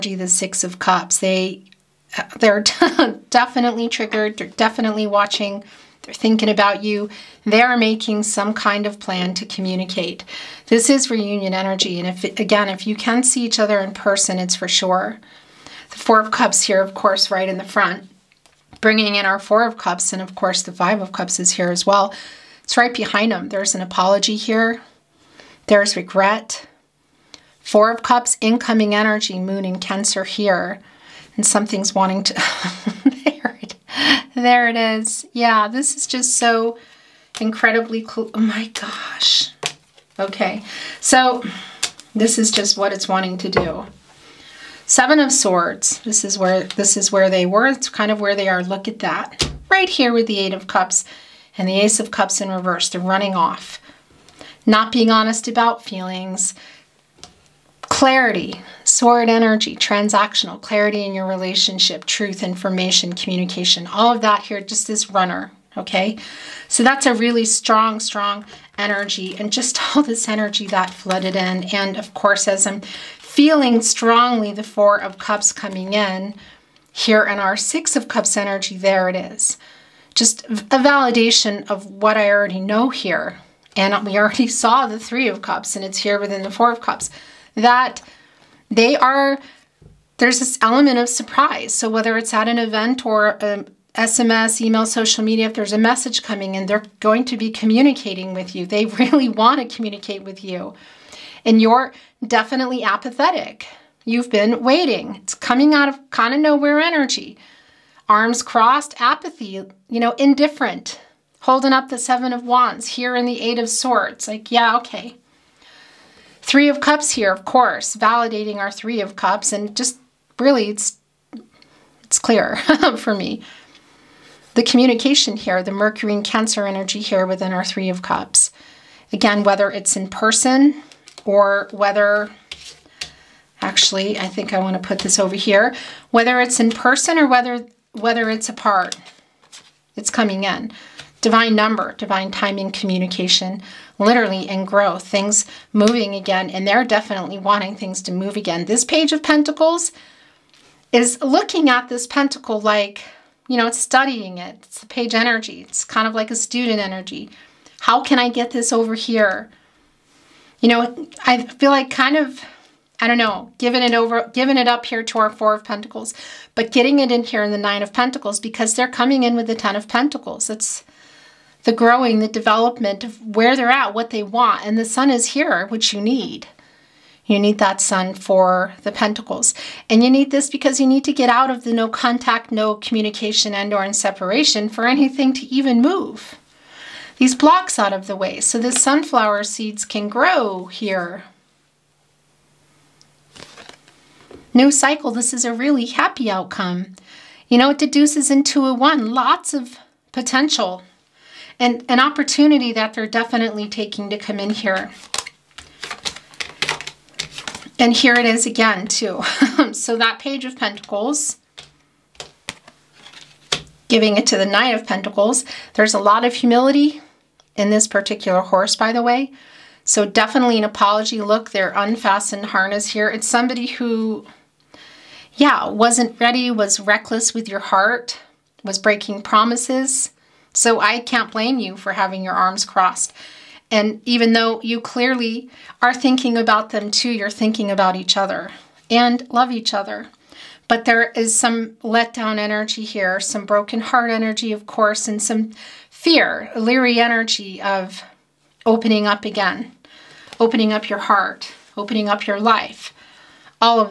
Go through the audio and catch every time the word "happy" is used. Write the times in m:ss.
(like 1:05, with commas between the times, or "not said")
3:15.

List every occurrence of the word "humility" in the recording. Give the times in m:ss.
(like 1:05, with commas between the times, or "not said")
3:36.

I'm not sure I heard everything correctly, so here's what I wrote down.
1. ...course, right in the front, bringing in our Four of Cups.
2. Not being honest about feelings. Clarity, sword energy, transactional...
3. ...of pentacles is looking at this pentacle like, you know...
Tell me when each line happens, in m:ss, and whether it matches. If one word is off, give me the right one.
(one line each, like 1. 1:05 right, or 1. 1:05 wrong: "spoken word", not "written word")
1. 0:16 right
2. 0:54 right
3. 2:29 right.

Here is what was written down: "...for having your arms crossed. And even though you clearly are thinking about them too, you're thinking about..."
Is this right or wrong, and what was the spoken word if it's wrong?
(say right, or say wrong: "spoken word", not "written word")
right.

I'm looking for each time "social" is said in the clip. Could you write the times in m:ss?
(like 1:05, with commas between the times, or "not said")
1:34.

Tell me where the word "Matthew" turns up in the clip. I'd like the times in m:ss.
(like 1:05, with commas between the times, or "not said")
not said.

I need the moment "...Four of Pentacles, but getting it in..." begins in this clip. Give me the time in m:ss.
2:45.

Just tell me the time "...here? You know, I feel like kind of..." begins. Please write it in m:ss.
2:38.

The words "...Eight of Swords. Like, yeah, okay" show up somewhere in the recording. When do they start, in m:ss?
1:53.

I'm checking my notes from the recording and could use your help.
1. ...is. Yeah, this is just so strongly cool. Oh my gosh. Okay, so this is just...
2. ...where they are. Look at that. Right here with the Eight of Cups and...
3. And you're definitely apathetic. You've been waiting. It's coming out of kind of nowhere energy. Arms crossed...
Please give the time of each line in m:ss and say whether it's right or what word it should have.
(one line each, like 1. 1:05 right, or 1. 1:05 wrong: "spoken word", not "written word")
1. 0:34 wrong: "incredibly", not "strongly"
2. 0:48 right
3. 1:41 right.